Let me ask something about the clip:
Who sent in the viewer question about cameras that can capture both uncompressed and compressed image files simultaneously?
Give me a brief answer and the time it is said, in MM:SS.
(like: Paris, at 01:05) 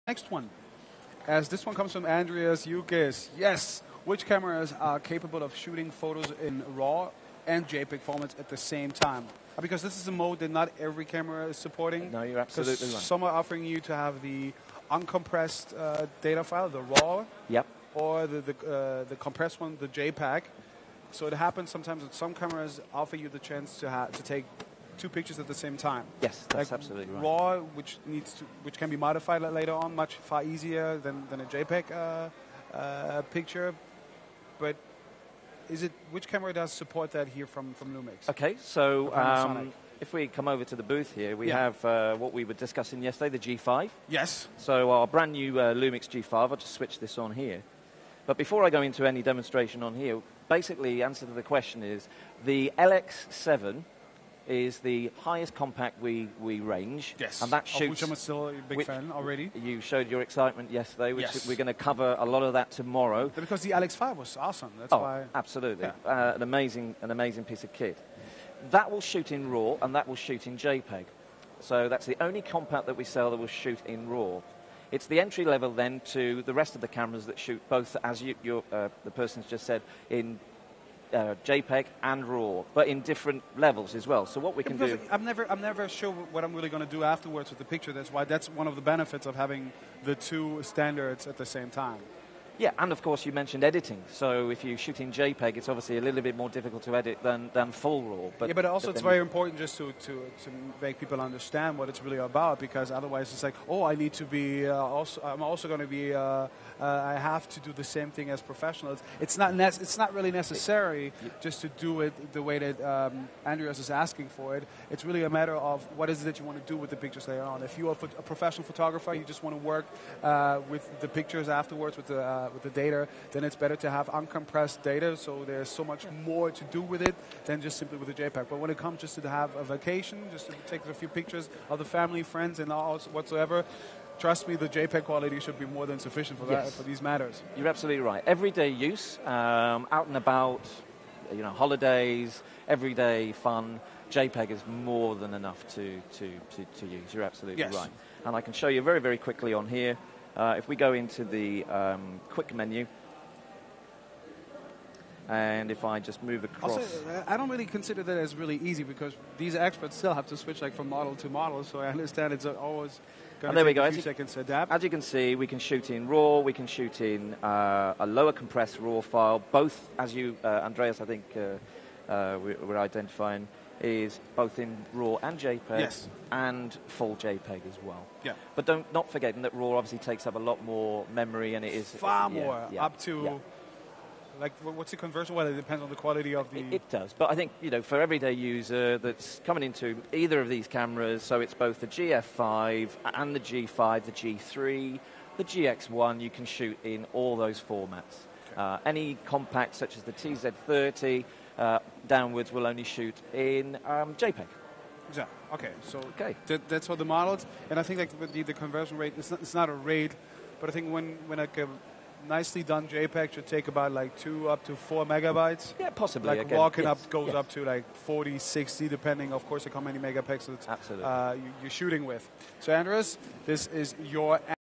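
Andreas Yukis, at 00:02.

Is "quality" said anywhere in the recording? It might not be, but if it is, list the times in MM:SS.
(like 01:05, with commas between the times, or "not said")
02:15, 03:05.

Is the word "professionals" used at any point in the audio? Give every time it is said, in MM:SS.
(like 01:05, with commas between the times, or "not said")
01:48, 01:58.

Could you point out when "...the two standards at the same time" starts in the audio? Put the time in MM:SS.
01:30.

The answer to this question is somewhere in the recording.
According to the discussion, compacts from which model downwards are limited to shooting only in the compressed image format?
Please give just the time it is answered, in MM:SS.
03:20.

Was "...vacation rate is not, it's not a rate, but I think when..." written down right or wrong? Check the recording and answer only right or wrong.
wrong.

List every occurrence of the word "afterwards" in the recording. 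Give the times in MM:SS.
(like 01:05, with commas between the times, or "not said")
01:27, 02:01.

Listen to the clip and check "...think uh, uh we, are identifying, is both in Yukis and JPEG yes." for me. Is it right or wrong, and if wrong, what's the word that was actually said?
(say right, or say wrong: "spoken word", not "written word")
wrong: "RAW", not "Yukis".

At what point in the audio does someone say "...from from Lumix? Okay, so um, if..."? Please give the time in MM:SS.
00:37.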